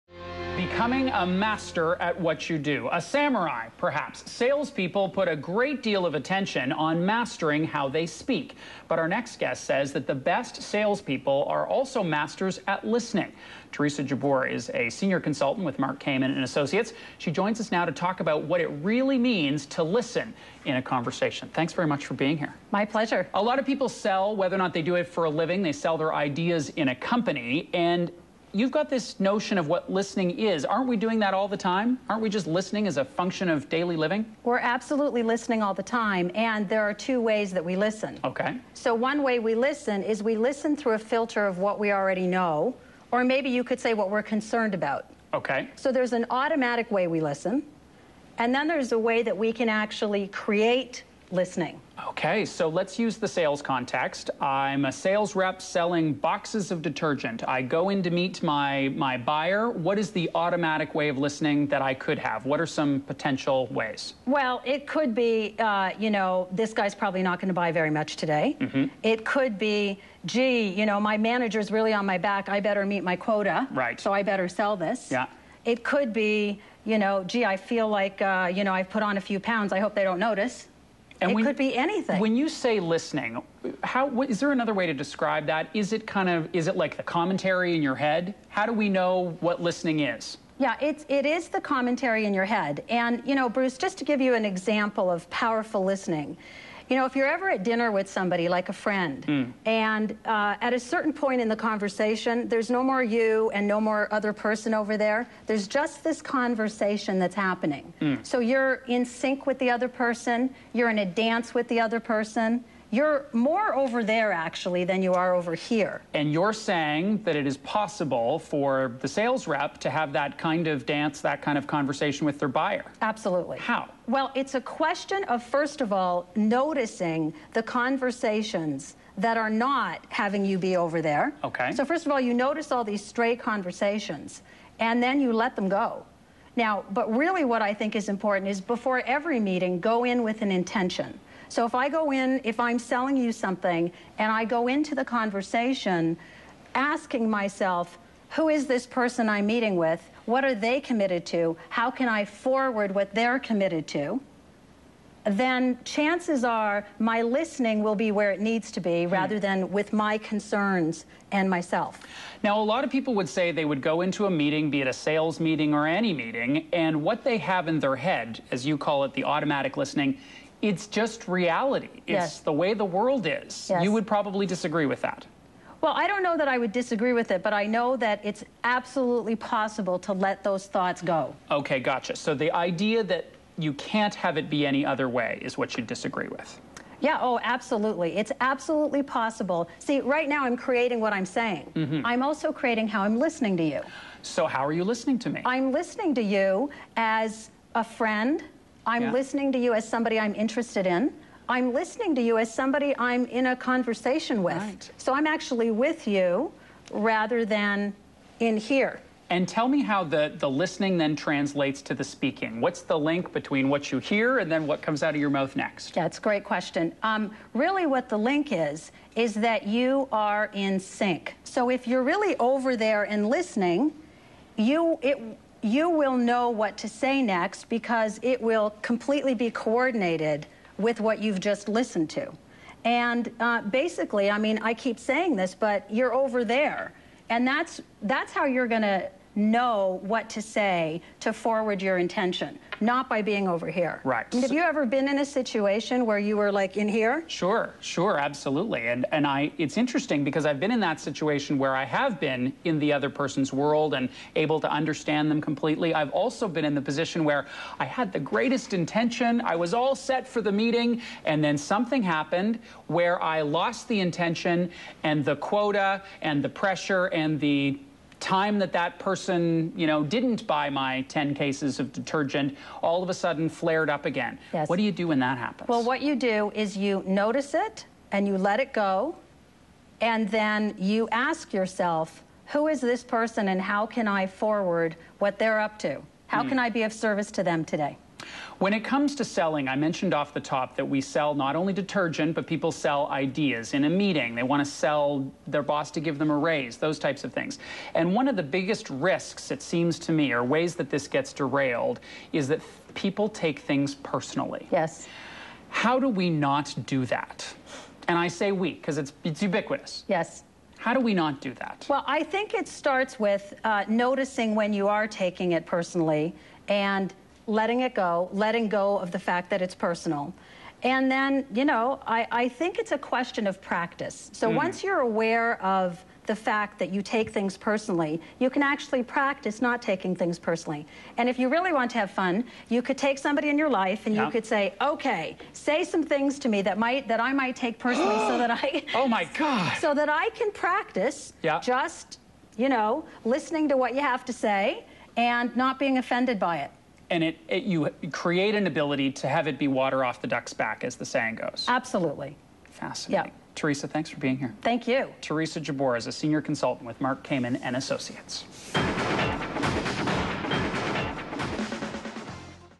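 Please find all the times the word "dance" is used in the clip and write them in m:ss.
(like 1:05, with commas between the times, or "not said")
1:51, 2:00.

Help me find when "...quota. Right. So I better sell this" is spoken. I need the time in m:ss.
1:13.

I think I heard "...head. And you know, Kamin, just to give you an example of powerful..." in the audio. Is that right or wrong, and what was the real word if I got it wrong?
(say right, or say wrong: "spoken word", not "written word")
wrong: "Bruce", not "Kamin".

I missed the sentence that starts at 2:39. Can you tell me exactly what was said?
rather than with my concerns and myself.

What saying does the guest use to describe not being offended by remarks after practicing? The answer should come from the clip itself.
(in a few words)
water off the duck's back.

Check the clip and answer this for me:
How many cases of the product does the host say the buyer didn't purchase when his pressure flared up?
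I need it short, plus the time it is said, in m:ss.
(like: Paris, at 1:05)
10, at 4:31.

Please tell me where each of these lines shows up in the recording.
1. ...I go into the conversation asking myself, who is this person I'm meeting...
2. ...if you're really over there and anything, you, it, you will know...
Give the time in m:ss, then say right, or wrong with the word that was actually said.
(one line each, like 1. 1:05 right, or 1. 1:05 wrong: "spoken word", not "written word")
1. 2:24 right
2. 3:41 wrong: "listening", not "anything".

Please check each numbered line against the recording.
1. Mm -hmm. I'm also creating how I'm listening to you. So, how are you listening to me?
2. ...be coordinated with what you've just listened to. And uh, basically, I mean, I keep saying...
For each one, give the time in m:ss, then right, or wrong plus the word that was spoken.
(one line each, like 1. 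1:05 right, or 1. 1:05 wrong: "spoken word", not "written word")
1. 3:11 right
2. 3:49 right.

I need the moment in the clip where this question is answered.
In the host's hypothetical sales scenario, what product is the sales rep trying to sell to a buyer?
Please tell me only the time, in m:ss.
0:56.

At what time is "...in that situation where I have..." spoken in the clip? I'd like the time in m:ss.
4:10.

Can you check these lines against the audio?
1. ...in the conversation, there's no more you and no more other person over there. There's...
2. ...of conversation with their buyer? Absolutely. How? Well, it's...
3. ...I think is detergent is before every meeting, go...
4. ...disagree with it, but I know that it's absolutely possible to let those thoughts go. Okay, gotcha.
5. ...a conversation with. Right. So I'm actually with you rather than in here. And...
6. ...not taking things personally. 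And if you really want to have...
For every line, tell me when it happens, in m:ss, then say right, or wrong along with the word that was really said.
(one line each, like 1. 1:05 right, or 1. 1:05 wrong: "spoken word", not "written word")
1. 1:41 right
2. 2:01 right
3. 2:17 wrong: "important", not "detergent"
4. 2:56 right
5. 3:23 right
6. 5:29 right.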